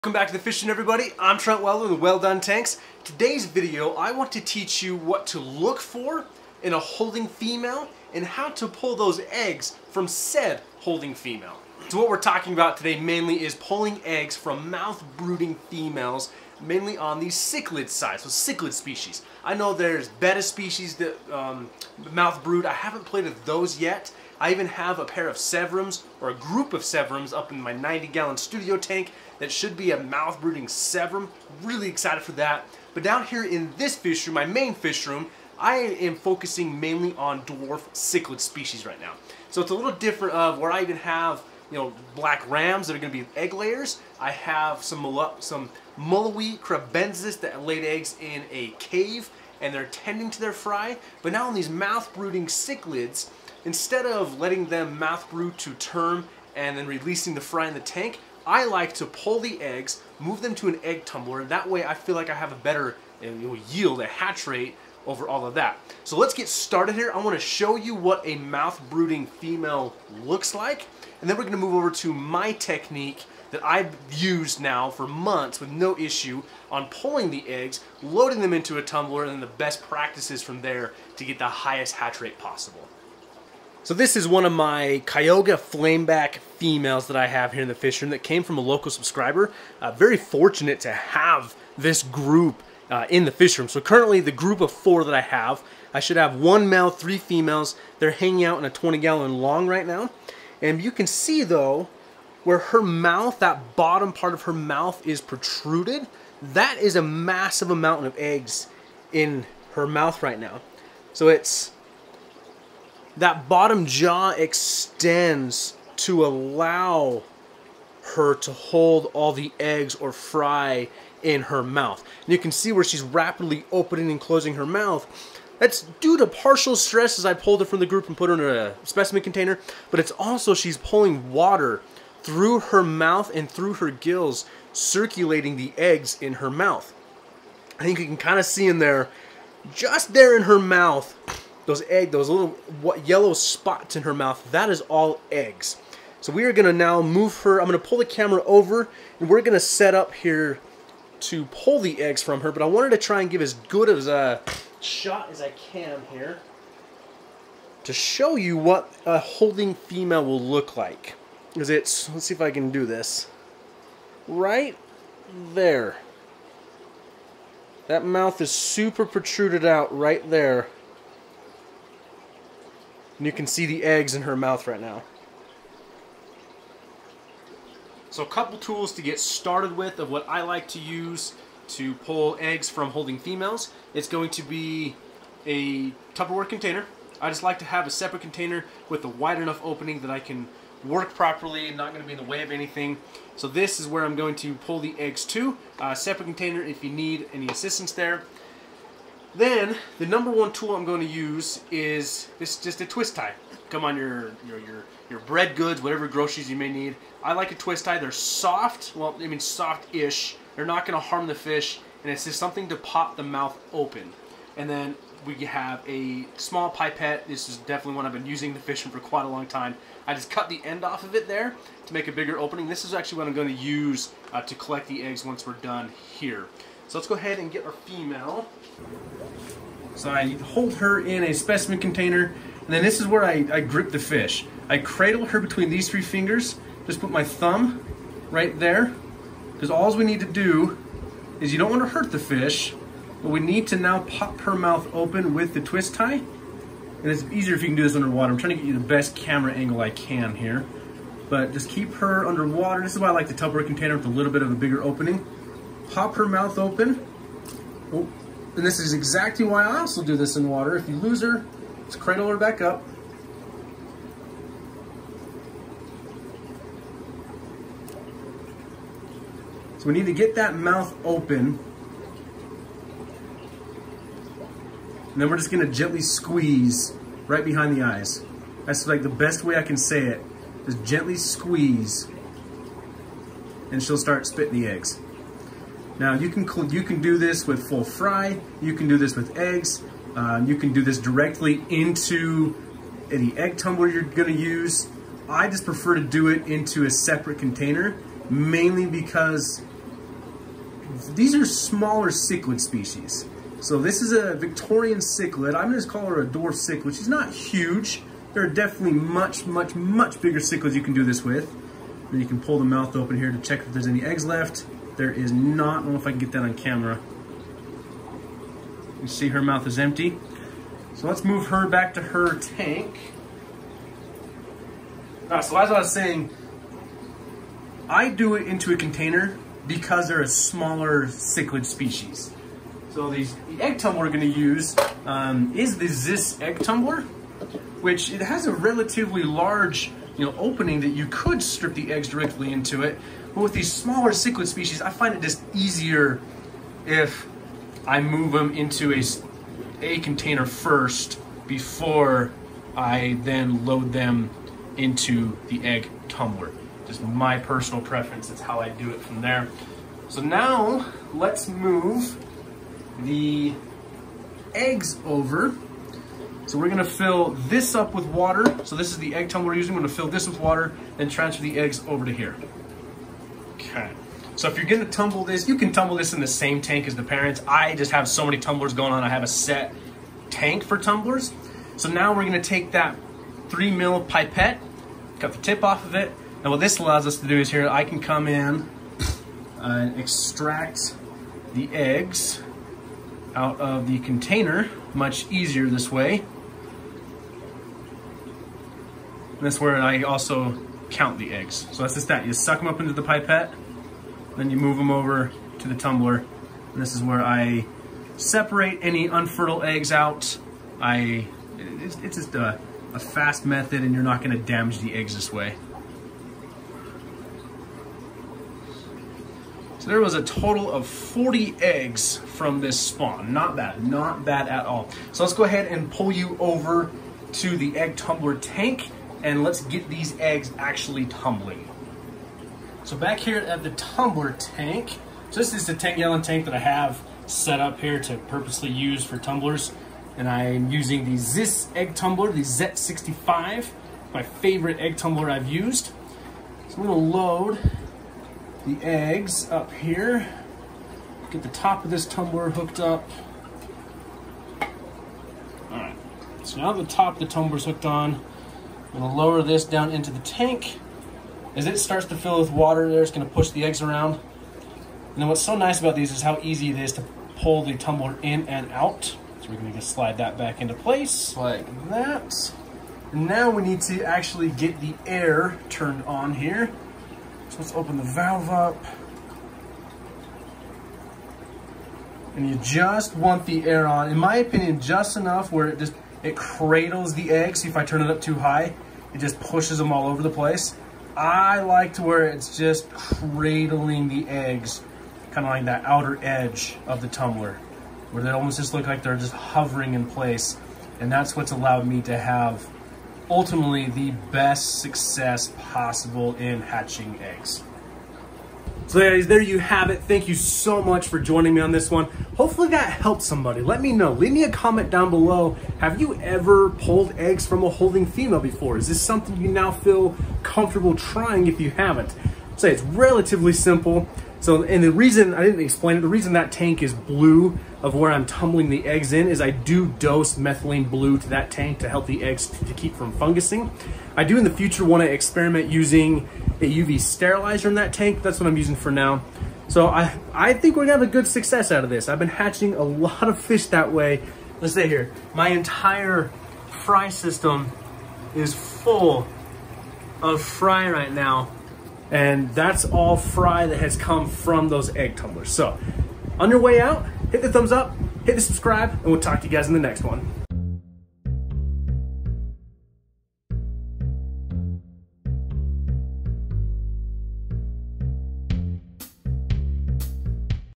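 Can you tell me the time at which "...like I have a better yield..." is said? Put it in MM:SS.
01:02.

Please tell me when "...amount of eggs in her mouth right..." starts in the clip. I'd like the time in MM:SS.
01:47.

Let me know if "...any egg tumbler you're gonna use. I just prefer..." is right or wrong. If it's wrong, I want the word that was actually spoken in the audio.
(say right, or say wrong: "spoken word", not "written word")
right.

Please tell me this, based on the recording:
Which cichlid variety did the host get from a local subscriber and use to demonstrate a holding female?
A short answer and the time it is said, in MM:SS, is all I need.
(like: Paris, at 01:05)
Kyoga Flameback, at 01:25.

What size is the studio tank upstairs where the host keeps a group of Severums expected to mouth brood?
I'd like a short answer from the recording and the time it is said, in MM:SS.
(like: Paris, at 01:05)
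90 gallon, at 00:27.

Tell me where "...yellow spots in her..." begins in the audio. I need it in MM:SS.
02:23.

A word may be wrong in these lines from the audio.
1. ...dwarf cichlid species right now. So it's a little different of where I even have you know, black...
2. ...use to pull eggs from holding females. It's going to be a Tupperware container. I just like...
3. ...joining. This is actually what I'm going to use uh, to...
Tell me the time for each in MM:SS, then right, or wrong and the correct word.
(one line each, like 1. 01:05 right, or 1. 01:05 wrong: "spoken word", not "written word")
1. 00:37 right
2. 03:00 right
3. 03:42 wrong: "opening", not "joining".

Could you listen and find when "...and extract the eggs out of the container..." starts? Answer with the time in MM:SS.
06:29.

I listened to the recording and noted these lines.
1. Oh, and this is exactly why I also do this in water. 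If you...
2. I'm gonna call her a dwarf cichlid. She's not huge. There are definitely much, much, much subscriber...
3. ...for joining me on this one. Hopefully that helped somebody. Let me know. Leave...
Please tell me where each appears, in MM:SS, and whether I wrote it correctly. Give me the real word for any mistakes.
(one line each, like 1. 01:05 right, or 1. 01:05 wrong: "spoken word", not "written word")
1. 04:17 right
2. 05:05 wrong: "bigger", not "subscriber"
3. 08:31 right.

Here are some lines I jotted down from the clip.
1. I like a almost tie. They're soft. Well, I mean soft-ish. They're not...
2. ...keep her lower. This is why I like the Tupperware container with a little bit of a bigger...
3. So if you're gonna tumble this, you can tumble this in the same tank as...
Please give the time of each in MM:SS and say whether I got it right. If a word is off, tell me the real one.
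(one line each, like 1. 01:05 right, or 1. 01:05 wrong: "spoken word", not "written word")
1. 03:27 wrong: "twist", not "almost"
2. 04:11 wrong: "underwater", not "lower"
3. 06:14 right.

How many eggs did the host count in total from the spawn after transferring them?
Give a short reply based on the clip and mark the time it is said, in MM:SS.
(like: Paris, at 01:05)
40, at 07:00.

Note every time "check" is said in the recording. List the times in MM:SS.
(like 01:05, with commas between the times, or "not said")
05:13.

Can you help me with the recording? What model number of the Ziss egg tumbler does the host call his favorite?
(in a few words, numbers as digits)
Z65.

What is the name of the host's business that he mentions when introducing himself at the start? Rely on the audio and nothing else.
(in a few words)
Wel-Don Tanks.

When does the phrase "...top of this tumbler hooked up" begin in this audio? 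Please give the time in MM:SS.
07:31.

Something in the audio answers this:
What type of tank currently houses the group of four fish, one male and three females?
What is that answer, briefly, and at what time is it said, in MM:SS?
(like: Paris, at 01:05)
20 gallon long, at 01:38.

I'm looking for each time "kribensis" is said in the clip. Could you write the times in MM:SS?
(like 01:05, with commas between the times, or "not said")
00:46.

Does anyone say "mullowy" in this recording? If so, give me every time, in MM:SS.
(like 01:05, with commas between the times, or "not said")
00:45.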